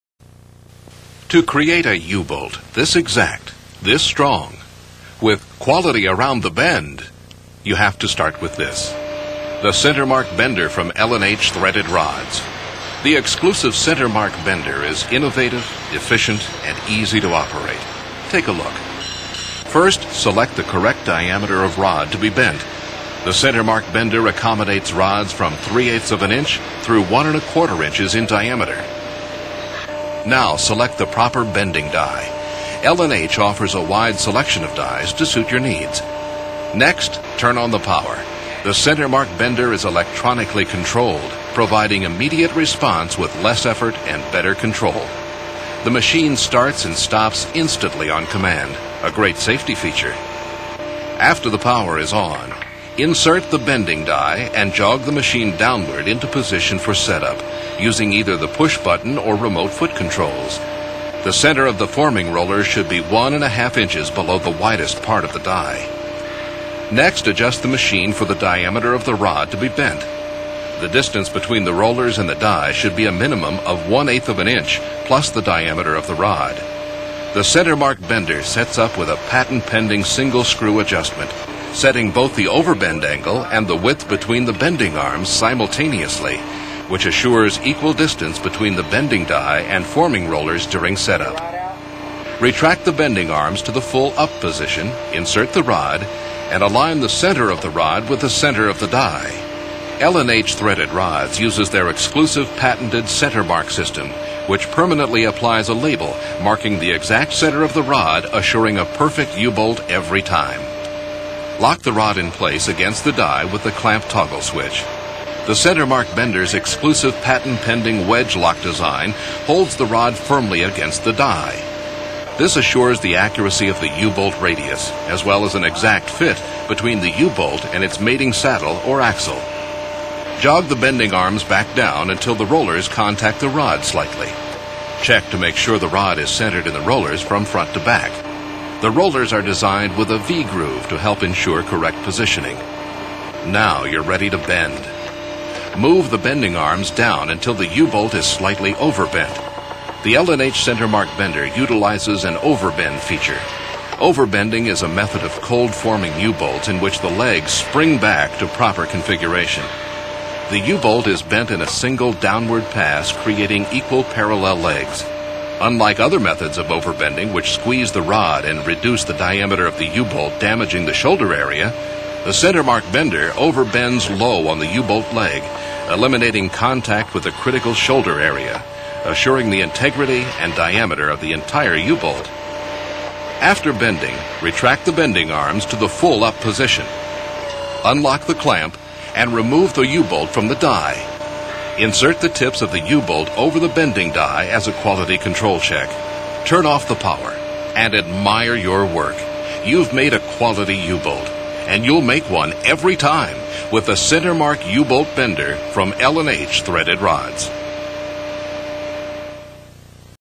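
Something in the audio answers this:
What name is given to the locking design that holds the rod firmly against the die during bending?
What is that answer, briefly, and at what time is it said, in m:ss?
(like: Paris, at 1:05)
wedge lock, at 1:58.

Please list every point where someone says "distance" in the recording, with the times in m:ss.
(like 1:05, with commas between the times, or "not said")
1:10, 1:27.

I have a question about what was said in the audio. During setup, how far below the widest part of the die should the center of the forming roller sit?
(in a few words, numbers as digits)
1.5 inches.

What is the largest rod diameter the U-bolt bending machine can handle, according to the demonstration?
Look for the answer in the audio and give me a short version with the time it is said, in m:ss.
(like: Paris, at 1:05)
1 1/4 inches, at 0:27.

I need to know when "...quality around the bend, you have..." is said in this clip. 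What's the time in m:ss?
0:05.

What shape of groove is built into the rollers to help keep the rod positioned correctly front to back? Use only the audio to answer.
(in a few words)
V-groove.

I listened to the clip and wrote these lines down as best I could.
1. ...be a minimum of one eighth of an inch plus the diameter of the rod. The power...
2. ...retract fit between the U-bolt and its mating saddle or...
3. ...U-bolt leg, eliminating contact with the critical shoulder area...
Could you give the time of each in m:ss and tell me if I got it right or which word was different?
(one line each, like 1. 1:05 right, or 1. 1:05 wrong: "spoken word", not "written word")
1. 1:12 wrong: "center", not "power"
2. 2:05 wrong: "exact", not "retract"
3. 2:54 right.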